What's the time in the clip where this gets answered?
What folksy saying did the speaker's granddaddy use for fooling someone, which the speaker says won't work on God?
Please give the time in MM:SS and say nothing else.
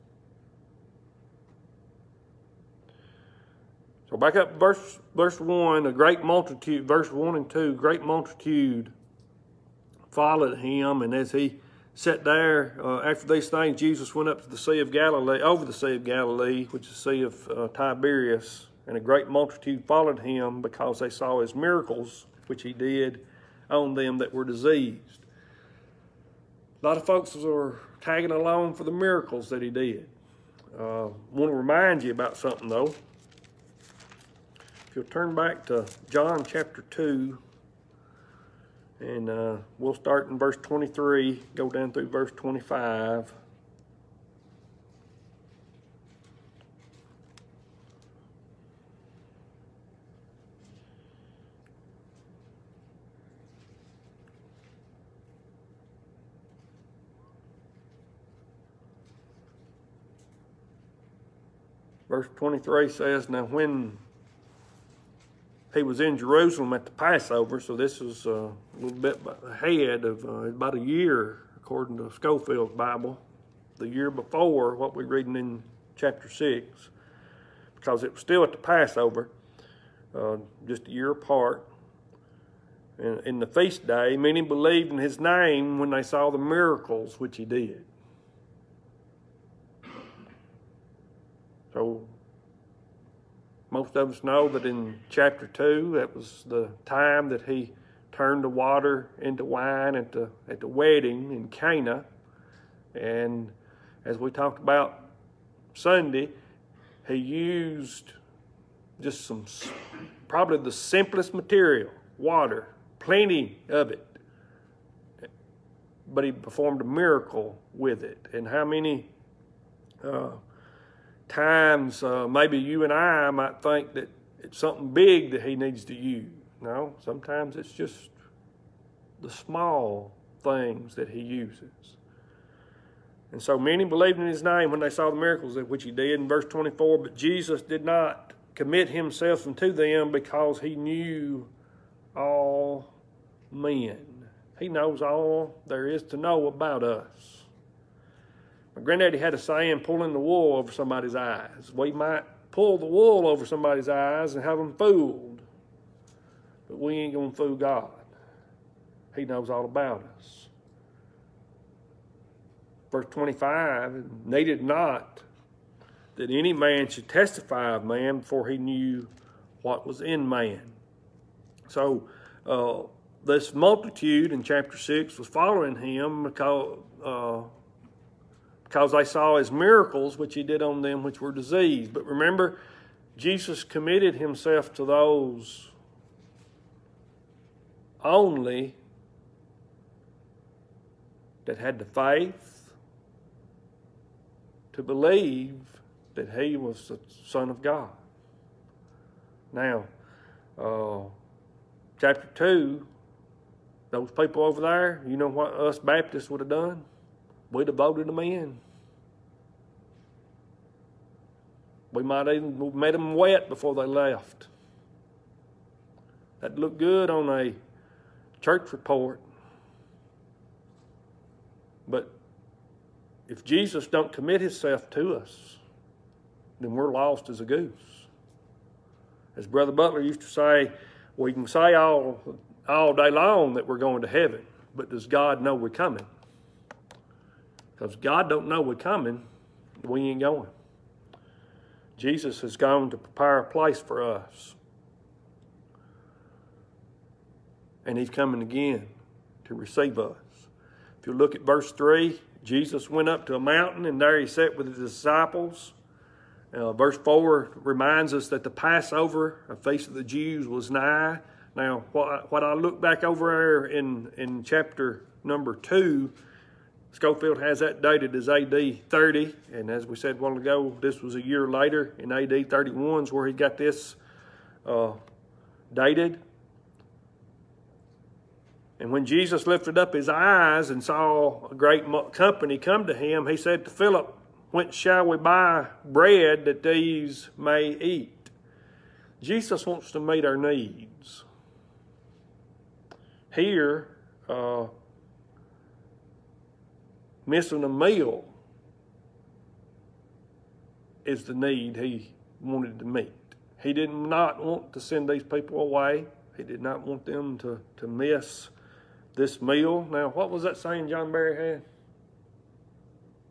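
02:29.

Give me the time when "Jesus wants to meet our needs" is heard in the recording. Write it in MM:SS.
04:49.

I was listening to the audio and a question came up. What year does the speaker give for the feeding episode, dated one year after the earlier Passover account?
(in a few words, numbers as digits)
AD 31.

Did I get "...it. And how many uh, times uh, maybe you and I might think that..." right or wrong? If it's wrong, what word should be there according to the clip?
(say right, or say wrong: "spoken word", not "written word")
right.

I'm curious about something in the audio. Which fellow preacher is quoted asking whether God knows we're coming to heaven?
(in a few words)
Brother Butler.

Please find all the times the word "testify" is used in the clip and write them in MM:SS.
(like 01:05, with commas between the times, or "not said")
02:47.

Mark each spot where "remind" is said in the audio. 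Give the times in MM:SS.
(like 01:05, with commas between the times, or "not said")
00:31, 04:17.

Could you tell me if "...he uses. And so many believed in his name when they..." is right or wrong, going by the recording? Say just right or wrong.
right.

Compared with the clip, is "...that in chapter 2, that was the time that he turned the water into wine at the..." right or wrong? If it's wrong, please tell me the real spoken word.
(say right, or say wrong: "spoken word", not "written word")
right.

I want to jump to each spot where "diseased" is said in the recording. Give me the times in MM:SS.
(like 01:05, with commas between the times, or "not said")
00:24, 03:01.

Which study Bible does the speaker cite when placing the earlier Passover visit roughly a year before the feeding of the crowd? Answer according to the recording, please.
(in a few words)
Scofield's Bible.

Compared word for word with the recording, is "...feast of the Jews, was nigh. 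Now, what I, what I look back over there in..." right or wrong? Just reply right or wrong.
right.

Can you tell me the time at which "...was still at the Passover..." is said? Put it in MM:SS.
01:18.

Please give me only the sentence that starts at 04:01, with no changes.
Jesus has gone to prepare a place for us.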